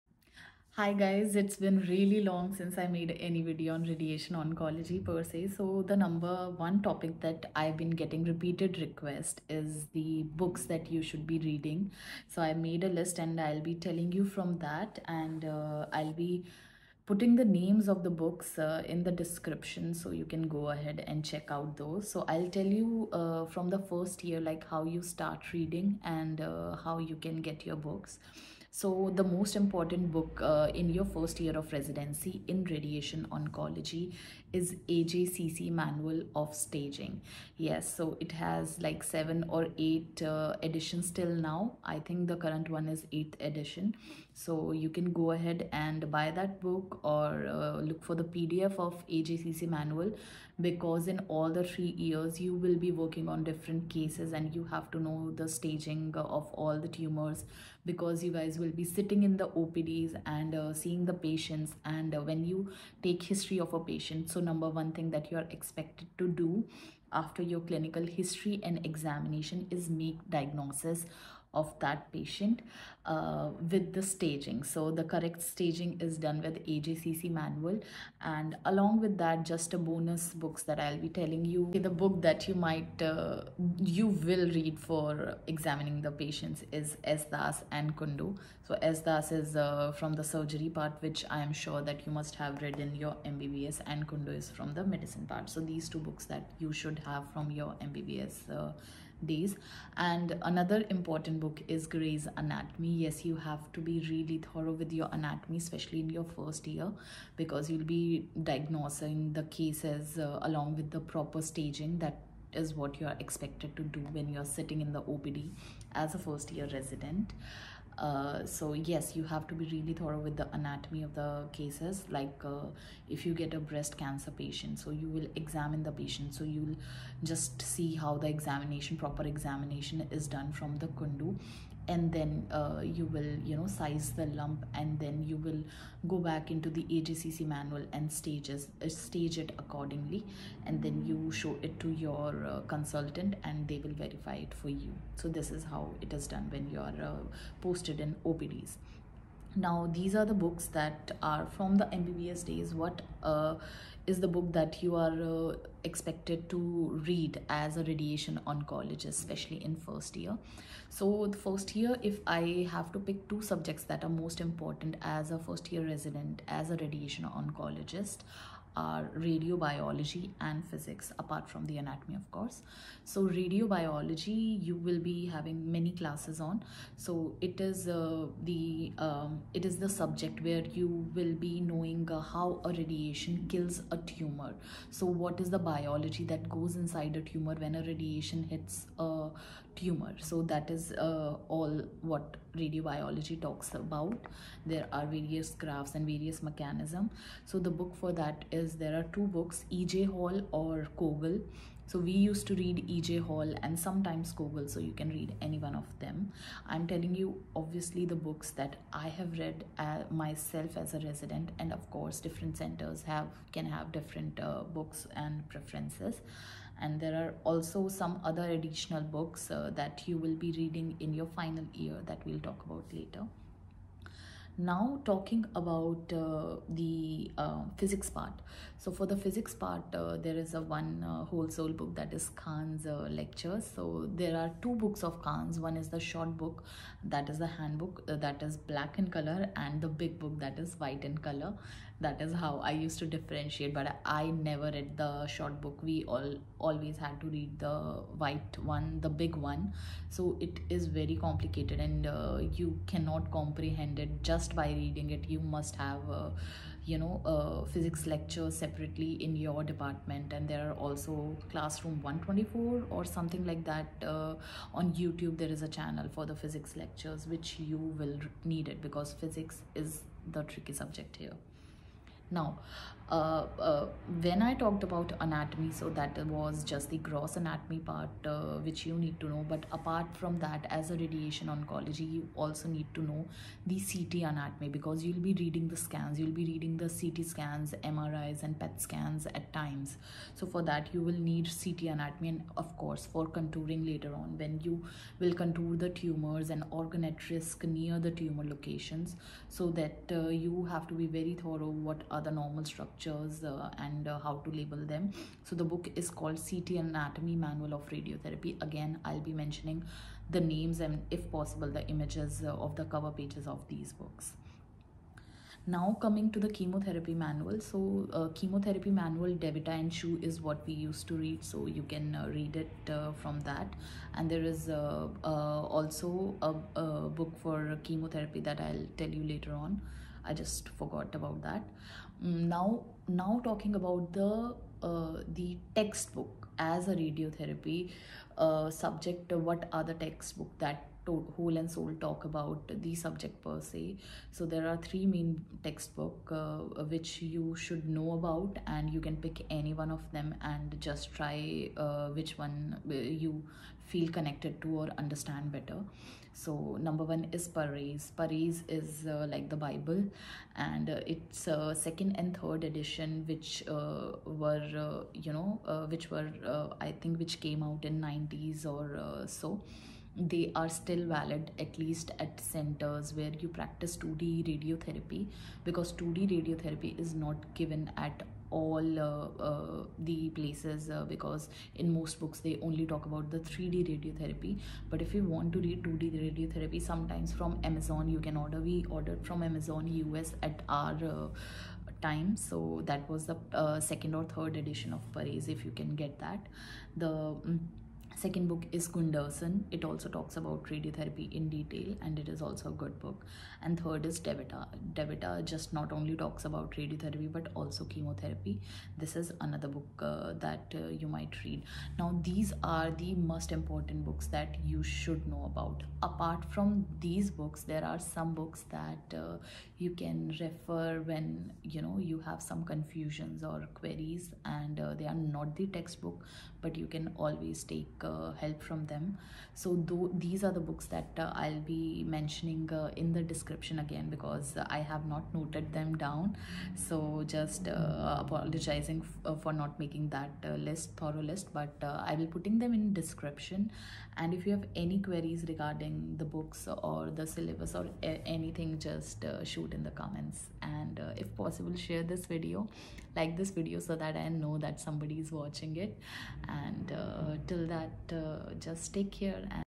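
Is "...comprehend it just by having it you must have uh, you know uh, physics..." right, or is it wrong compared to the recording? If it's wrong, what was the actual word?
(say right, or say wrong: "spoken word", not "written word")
wrong: "reading", not "having".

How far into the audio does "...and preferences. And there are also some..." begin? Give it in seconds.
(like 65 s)
215 s.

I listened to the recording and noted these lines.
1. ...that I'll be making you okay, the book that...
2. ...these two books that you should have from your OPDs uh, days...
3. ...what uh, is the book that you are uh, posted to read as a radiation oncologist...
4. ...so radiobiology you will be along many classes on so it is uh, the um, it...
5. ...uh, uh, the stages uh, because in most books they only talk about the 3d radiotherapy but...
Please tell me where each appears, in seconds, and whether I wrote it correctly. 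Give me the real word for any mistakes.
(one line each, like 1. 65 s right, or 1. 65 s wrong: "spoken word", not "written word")
1. 80 s wrong: "telling", not "making"
2. 95 s wrong: "MBBS", not "OPDs"
3. 152 s wrong: "expected", not "posted"
4. 173 s wrong: "having", not "along"
5. 378 s wrong: "places", not "stages".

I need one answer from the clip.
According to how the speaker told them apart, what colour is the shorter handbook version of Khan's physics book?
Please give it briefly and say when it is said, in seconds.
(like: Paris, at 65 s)
Black, at 238 s.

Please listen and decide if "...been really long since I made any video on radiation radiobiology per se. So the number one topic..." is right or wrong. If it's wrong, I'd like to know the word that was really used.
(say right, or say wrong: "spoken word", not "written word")
wrong: "oncology", not "radiobiology".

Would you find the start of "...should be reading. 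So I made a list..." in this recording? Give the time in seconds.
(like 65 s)
11 s.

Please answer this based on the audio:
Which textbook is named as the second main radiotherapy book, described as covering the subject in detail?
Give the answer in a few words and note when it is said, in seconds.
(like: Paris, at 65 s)
Gunderson, at 398 s.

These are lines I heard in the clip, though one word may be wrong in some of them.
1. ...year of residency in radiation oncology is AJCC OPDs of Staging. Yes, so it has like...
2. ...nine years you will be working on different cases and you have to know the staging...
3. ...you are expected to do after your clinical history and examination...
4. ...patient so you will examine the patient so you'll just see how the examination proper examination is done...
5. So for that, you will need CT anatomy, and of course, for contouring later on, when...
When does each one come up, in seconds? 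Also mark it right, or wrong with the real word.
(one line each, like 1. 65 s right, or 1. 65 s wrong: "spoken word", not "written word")
1. 31 s wrong: "Manual", not "OPDs"
2. 51 s wrong: "three", not "nine"
3. 65 s right
4. 124 s right
5. 290 s right.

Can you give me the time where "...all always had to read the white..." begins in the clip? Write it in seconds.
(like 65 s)
246 s.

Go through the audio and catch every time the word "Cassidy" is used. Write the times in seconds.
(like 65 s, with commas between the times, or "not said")
not said.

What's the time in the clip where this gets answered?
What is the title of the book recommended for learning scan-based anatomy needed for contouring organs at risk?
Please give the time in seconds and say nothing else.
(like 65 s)
306 s.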